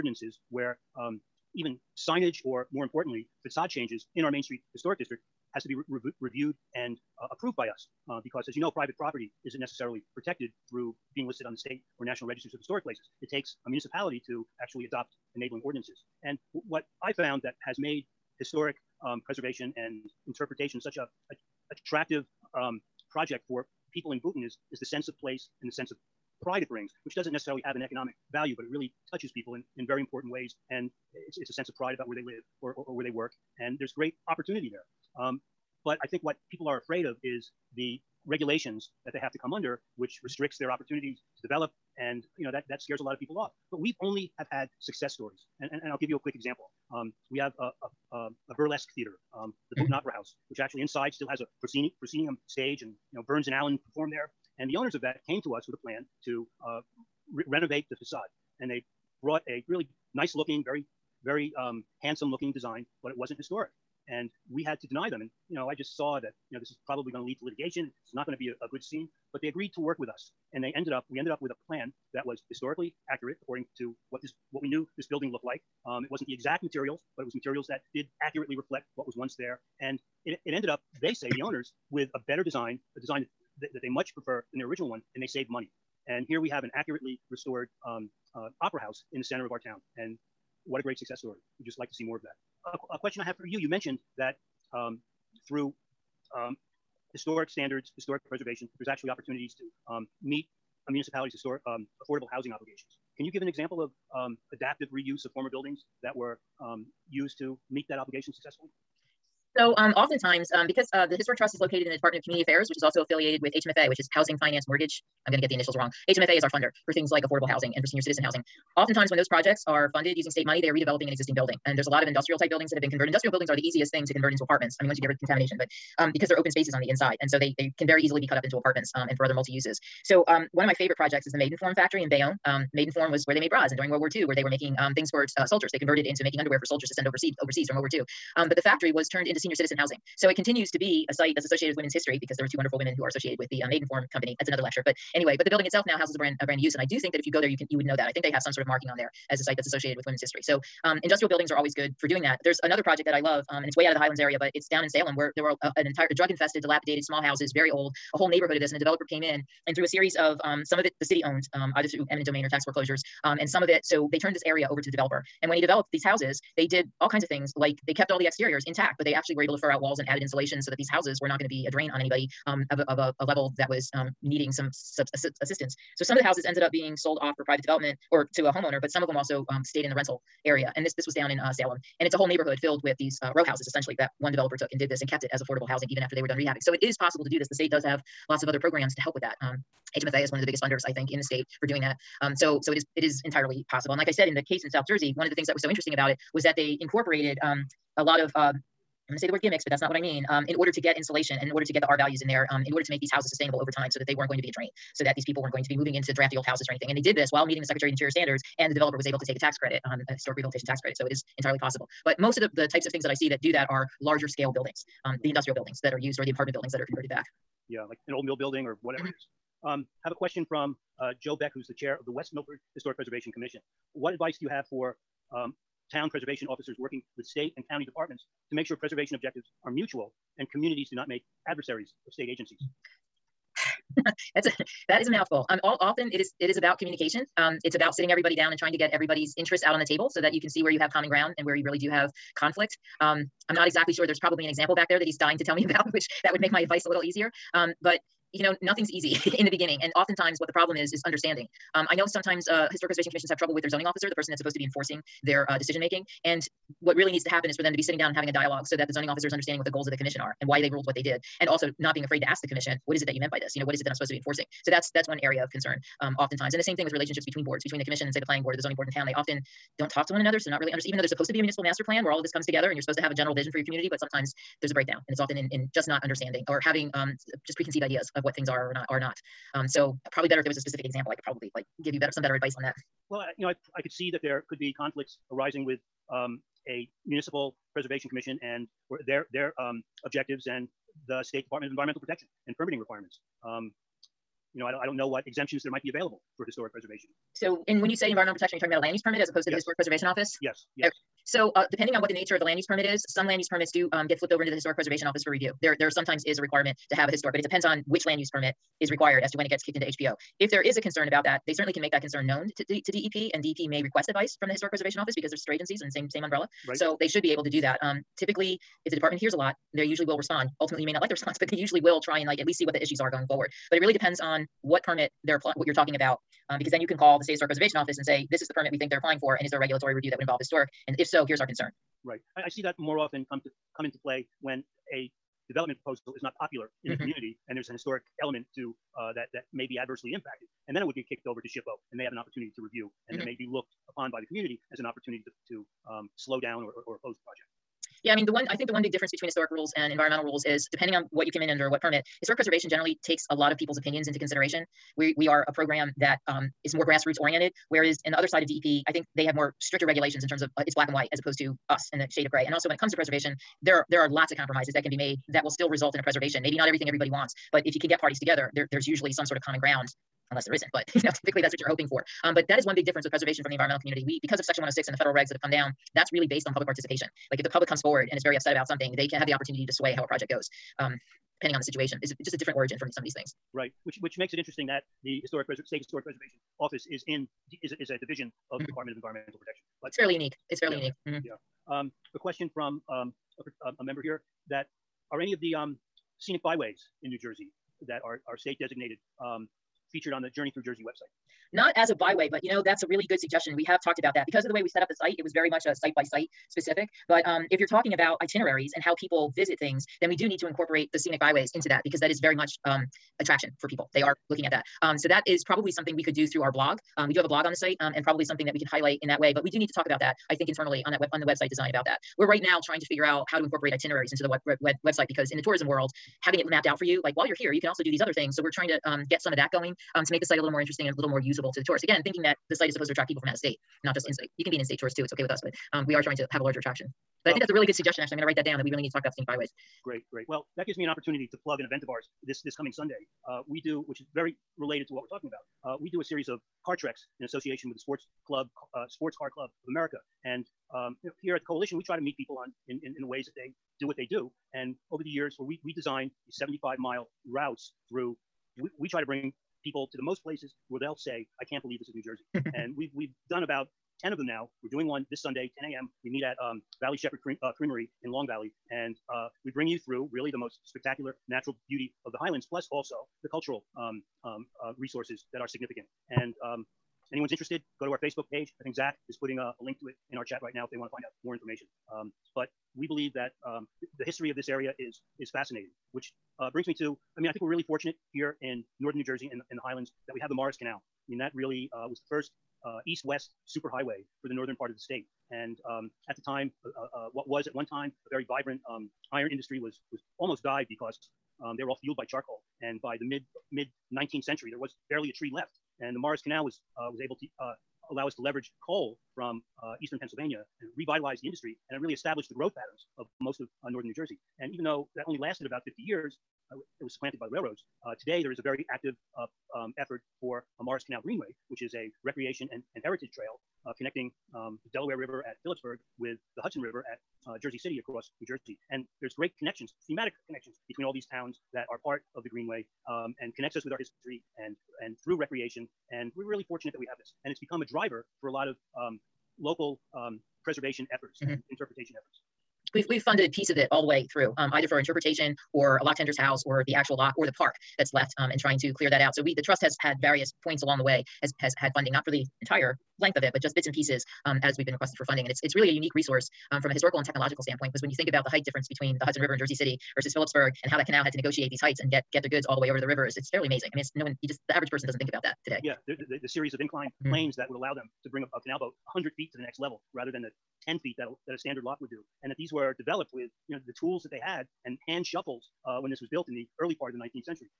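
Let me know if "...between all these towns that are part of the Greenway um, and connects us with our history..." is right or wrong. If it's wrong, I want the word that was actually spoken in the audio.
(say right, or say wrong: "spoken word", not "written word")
right.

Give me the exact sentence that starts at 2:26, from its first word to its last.
And I do think that if you go there, you can you would know that.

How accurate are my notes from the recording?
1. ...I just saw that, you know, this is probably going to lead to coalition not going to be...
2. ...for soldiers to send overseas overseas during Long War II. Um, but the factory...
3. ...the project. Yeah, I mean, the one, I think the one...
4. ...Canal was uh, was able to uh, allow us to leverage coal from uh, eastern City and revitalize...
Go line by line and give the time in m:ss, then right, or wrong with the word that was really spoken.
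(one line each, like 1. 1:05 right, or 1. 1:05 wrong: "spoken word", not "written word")
1. 1:05 wrong: "litigation", not "coalition"
2. 2:16 wrong: "World", not "Long"
3. 5:47 right
4. 8:26 wrong: "Pennsylvania", not "City".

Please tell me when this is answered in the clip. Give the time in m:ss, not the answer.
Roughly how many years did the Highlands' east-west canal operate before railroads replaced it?
8:35.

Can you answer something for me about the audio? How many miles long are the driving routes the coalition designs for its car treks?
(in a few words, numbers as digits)
75.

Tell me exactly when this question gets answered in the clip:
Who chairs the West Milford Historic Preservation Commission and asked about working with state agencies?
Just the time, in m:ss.
3:41.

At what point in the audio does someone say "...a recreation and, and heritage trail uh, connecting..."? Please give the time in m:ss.
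8:41.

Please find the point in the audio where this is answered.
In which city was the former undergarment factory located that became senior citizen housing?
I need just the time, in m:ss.
2:12.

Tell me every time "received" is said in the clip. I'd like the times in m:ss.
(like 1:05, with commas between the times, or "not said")
not said.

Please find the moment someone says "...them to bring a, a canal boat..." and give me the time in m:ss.
9:27.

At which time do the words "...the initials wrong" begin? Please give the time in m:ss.
1:55.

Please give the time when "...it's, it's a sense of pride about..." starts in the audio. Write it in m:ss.
0:31.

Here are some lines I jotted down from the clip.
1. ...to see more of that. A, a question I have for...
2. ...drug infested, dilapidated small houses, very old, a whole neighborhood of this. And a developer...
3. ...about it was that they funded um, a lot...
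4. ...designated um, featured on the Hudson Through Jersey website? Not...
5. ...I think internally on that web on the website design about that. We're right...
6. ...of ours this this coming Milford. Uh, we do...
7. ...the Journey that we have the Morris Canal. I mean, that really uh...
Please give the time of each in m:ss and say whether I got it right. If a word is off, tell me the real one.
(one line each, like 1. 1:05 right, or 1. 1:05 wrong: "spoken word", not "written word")
1. 1:31 right
2. 2:36 right
3. 3:15 wrong: "incorporated", not "funded"
4. 6:38 wrong: "Journey", not "Hudson"
5. 7:00 right
6. 7:21 wrong: "Sunday", not "Milford"
7. 8:09 wrong: "Highlands", not "Journey".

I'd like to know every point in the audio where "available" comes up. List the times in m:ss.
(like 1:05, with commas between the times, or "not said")
4:55.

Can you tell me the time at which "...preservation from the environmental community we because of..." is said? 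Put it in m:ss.
6:13.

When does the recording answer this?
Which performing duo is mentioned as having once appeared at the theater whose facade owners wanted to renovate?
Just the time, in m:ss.
0:53.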